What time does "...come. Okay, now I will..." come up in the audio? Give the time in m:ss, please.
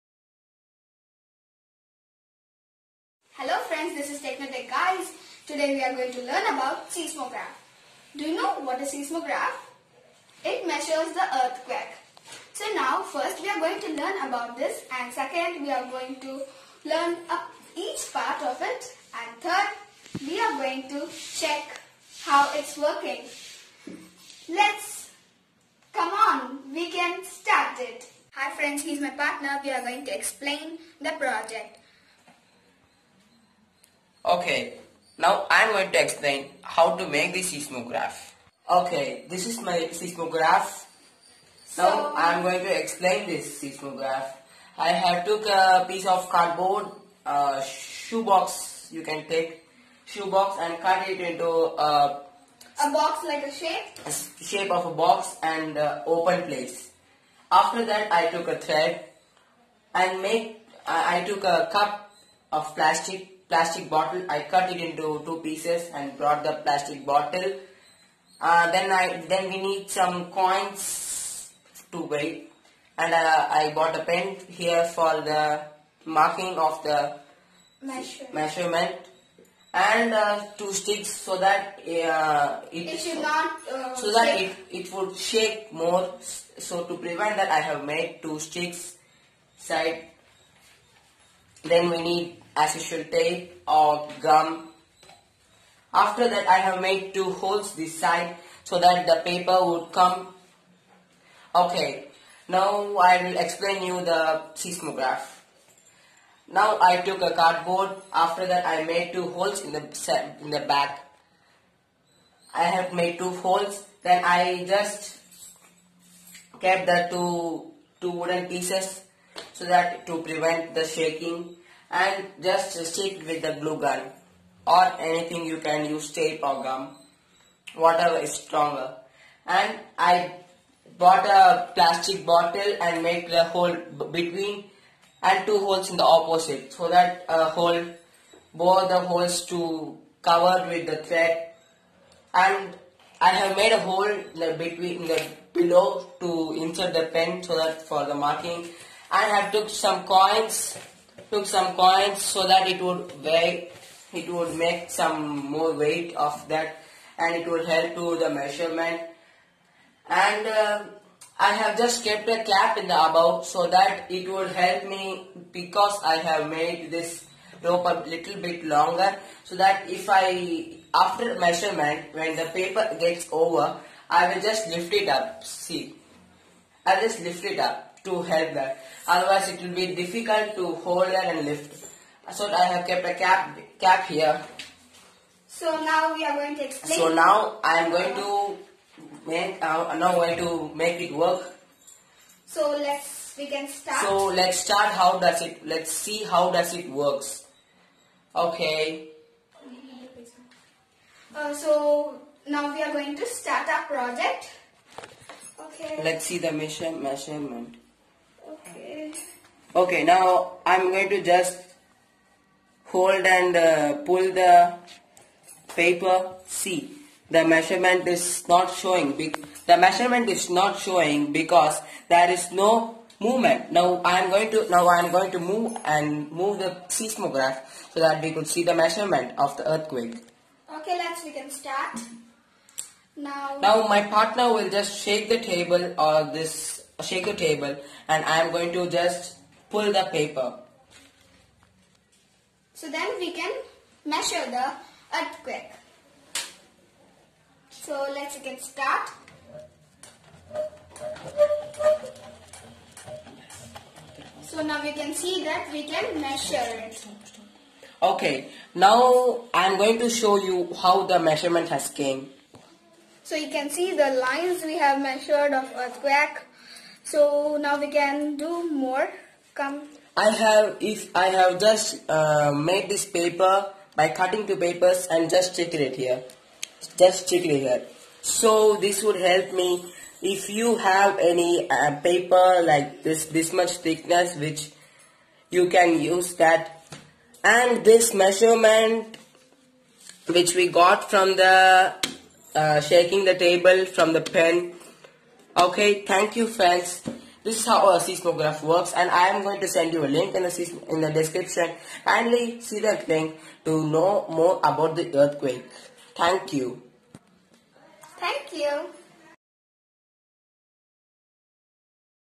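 1:39.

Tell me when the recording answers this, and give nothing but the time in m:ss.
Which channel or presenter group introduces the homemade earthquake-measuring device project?
0:04.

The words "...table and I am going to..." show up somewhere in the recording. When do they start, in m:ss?
3:57.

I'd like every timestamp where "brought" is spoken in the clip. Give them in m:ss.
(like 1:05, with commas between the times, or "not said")
1:06.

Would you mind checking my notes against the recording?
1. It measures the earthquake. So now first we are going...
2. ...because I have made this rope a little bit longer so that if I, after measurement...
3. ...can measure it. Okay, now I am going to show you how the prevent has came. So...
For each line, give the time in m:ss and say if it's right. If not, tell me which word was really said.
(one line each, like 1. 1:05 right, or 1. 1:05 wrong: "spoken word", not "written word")
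1. 0:10 right
2. 2:45 right
3. 4:15 wrong: "measurement", not "prevent".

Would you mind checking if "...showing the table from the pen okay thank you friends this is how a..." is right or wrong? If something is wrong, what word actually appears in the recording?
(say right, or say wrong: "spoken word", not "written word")
wrong: "shaking", not "showing".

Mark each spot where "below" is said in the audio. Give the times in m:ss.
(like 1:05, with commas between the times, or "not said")
2:25.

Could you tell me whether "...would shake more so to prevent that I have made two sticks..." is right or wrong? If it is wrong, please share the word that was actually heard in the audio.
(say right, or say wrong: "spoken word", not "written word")
right.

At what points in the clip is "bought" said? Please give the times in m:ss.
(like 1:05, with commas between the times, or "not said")
1:13, 2:10.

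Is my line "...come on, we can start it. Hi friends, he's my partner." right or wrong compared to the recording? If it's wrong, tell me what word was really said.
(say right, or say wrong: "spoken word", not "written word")
right.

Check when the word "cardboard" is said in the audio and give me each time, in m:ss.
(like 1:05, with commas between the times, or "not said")
0:46, 1:47.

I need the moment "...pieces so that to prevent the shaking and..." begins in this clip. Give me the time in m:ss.
1:58.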